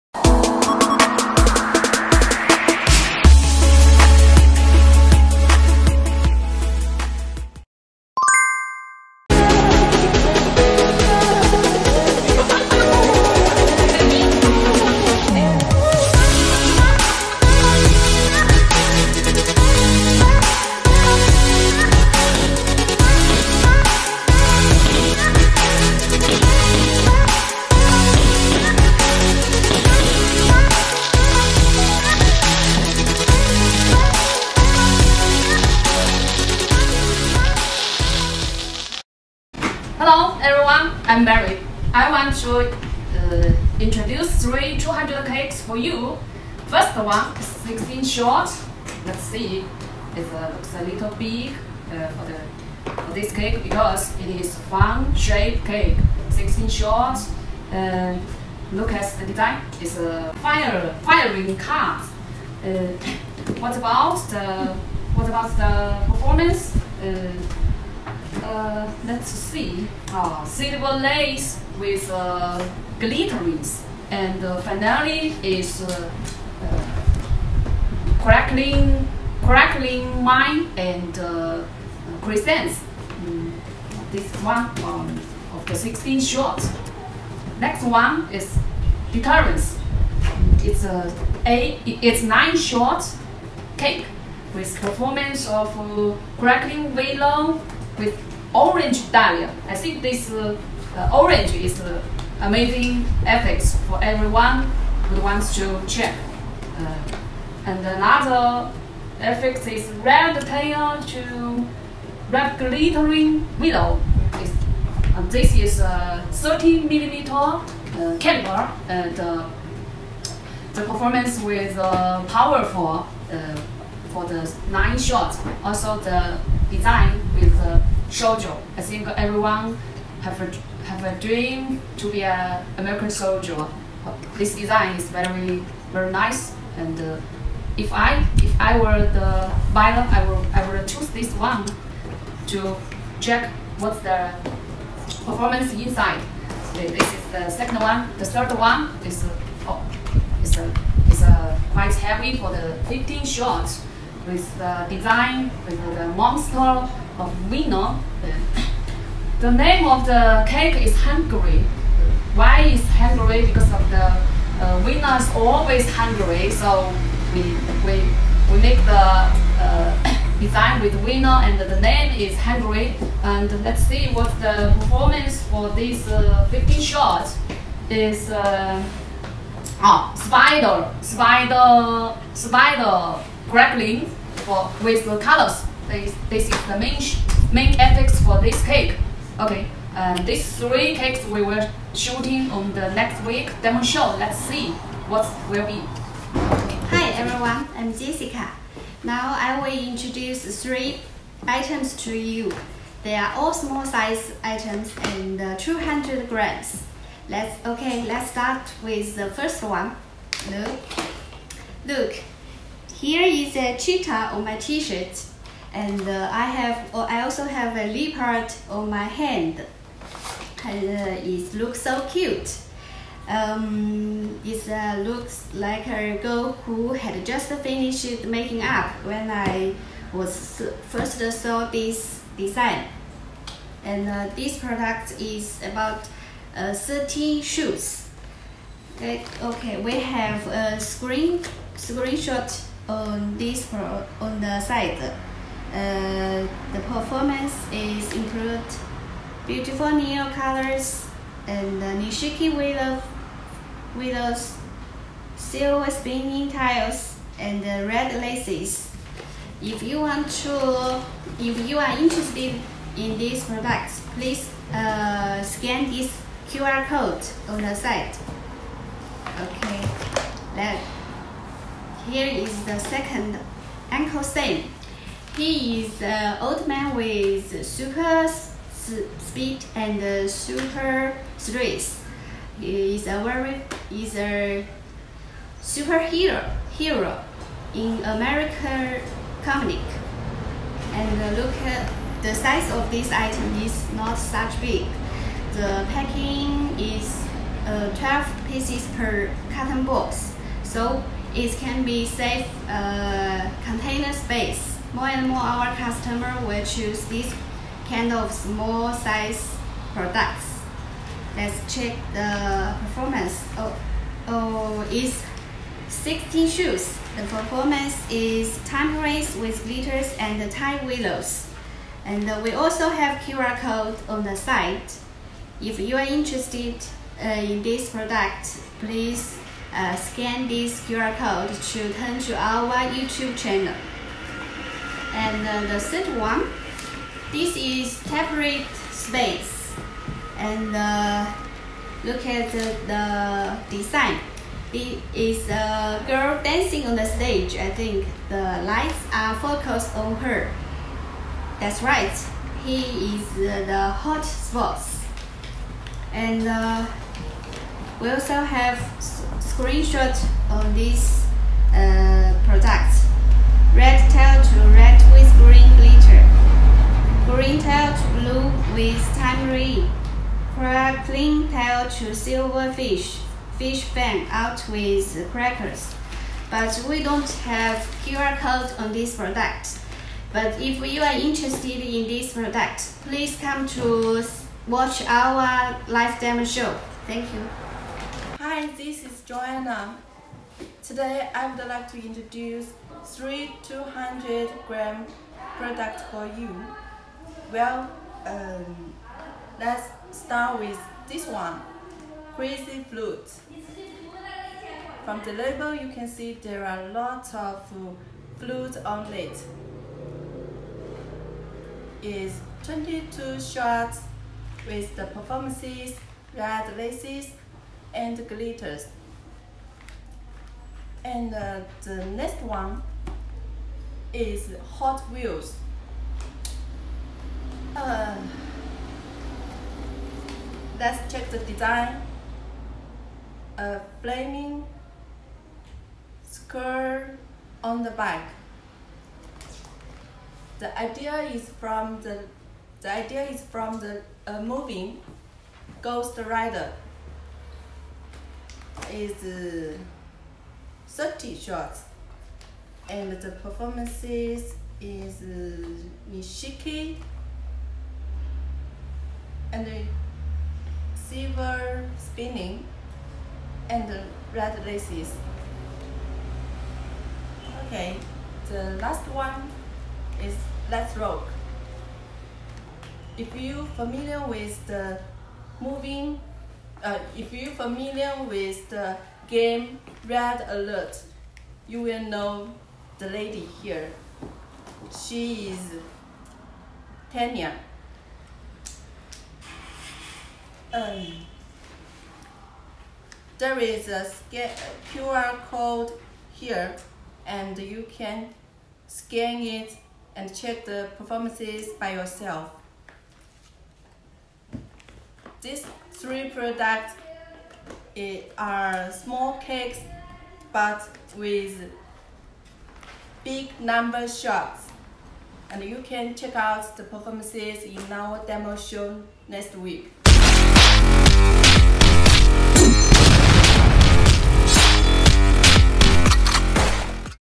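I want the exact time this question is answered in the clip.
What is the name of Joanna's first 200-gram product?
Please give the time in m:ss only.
6:42.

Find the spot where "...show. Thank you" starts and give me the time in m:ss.
6:26.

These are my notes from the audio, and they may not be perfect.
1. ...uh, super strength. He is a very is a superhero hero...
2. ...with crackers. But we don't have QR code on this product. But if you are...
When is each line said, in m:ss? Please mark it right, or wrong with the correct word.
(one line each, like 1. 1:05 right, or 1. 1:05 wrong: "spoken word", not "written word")
1. 4:40 right
2. 6:14 right.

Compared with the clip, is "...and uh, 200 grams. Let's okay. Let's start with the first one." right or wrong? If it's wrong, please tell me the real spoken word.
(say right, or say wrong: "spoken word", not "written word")
right.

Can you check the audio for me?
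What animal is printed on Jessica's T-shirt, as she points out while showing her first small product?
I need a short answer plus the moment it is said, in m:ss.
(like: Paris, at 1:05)
Cheetah, at 3:33.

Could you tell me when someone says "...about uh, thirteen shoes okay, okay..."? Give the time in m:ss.
3:55.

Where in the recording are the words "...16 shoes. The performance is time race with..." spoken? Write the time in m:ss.
5:15.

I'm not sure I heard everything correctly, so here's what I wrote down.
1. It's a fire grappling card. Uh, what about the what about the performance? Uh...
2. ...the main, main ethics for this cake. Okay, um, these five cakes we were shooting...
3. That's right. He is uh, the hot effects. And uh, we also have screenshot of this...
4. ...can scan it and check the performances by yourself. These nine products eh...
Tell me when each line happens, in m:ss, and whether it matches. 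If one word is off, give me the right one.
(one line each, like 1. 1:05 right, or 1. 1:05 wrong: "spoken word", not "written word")
1. 0:59 wrong: "firing", not "grappling"
2. 3:06 wrong: "three", not "five"
3. 5:51 wrong: "spots", not "effects"
4. 8:17 wrong: "three", not "nine".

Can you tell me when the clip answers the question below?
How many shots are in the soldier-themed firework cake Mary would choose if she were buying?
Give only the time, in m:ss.
1:32.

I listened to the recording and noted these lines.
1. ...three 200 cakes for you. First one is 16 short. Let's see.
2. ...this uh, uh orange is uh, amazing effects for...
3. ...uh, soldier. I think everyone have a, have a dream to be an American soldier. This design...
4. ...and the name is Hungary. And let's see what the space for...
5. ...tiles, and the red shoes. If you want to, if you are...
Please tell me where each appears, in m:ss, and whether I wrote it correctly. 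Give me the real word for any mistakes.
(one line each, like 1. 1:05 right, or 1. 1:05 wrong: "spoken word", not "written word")
1. 0:44 right
2. 1:40 right
3. 2:07 right
4. 2:51 wrong: "performance", not "space"
5. 4:16 wrong: "laces", not "shoes".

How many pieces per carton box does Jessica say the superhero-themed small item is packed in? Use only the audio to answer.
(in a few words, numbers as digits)
12.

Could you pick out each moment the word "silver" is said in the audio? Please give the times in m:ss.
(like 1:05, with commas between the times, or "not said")
1:10, 4:15, 6:12, 7:41.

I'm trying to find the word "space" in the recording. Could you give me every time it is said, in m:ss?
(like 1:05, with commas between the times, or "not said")
5:04, 5:38.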